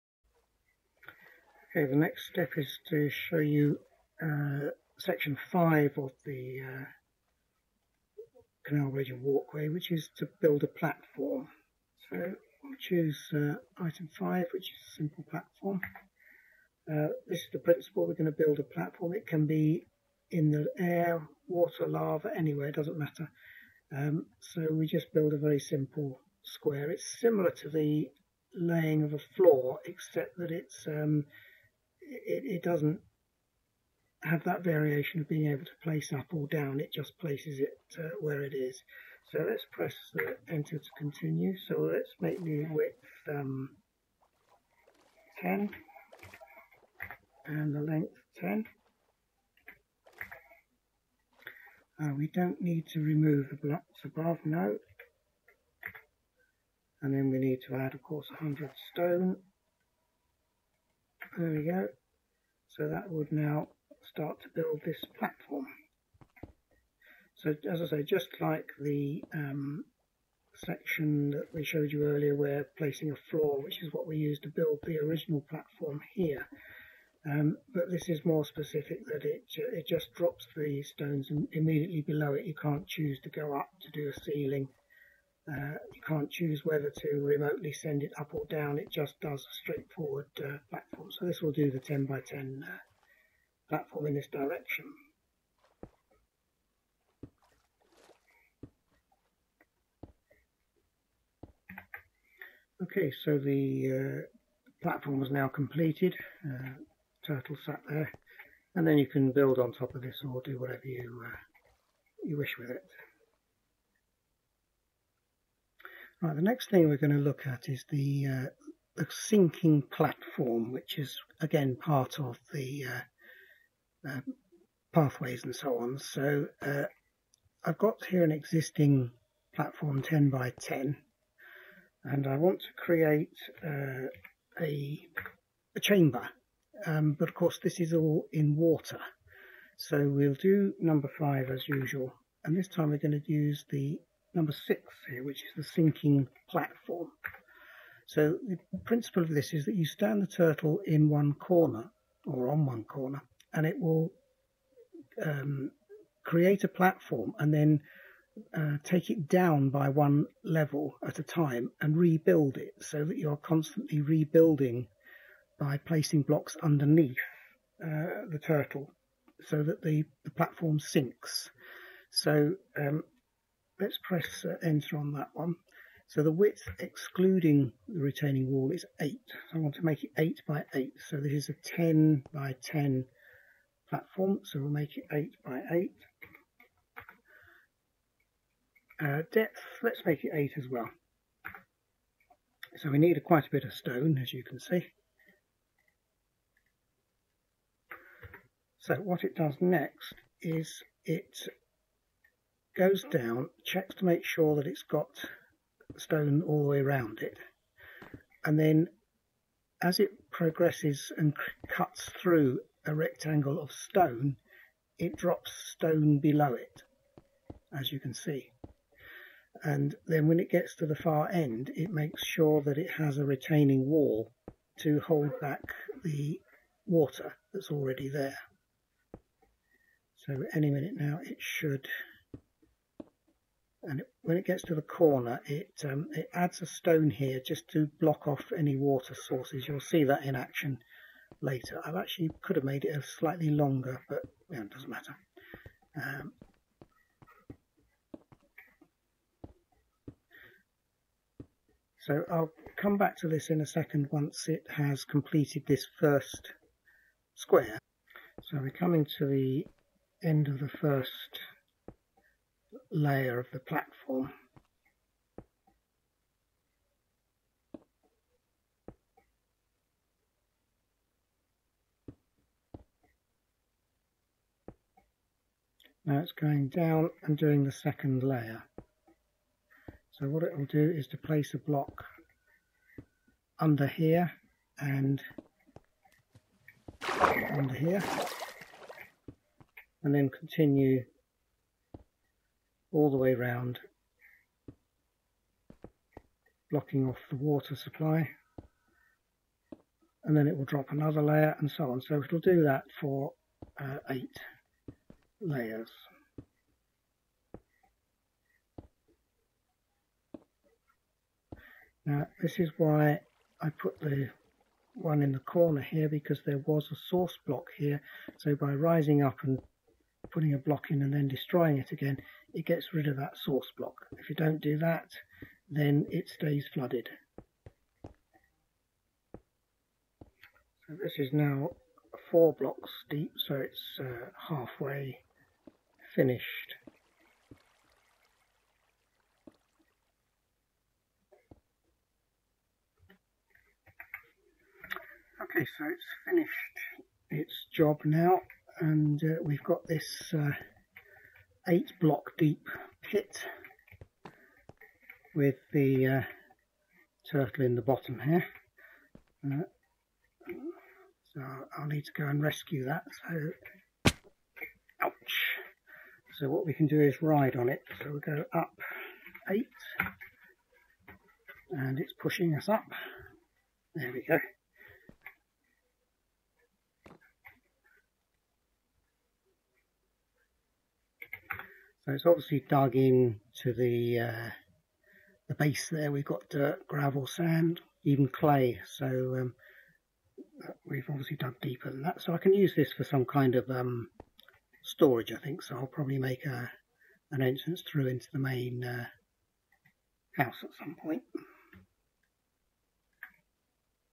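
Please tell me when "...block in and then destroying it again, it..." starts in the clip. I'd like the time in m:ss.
5:20.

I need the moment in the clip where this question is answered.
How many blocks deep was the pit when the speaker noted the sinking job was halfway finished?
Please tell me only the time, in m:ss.
5:32.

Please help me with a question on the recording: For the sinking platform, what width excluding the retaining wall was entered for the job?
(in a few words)
8.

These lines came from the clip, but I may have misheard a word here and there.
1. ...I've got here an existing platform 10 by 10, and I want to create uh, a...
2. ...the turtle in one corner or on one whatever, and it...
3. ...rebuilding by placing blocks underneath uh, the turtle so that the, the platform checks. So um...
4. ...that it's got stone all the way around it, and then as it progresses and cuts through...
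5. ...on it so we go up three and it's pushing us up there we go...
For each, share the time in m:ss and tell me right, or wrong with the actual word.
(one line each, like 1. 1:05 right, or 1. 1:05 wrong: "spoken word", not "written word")
1. 2:07 right
2. 2:30 wrong: "corner", not "whatever"
3. 2:44 wrong: "sinks", not "checks"
4. 3:24 right
5. 6:07 wrong: "eight", not "three".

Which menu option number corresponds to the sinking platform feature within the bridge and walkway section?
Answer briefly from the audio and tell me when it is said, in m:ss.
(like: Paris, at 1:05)
6, at 2:24.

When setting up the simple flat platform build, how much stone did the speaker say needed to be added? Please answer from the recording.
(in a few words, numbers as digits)
100.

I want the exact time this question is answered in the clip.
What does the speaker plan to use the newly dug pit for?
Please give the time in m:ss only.
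6:34.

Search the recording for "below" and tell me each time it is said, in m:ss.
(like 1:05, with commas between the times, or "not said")
1:22, 3:36.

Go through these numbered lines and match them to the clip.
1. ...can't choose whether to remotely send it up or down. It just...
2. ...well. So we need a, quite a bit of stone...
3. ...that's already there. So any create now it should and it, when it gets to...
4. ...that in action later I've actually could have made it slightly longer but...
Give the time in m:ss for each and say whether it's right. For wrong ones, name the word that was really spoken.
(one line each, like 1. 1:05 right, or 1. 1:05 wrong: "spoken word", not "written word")
1. 1:26 right
2. 3:10 right
3. 3:47 wrong: "minute", not "create"
4. 4:00 right.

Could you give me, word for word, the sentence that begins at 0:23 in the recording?
Um, so we just build a very simple square.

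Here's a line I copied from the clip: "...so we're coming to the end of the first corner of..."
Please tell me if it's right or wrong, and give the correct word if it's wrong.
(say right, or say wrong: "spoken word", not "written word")
wrong: "layer", not "corner".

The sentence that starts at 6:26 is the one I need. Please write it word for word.
We've got dirt, gravel, sand, even clay.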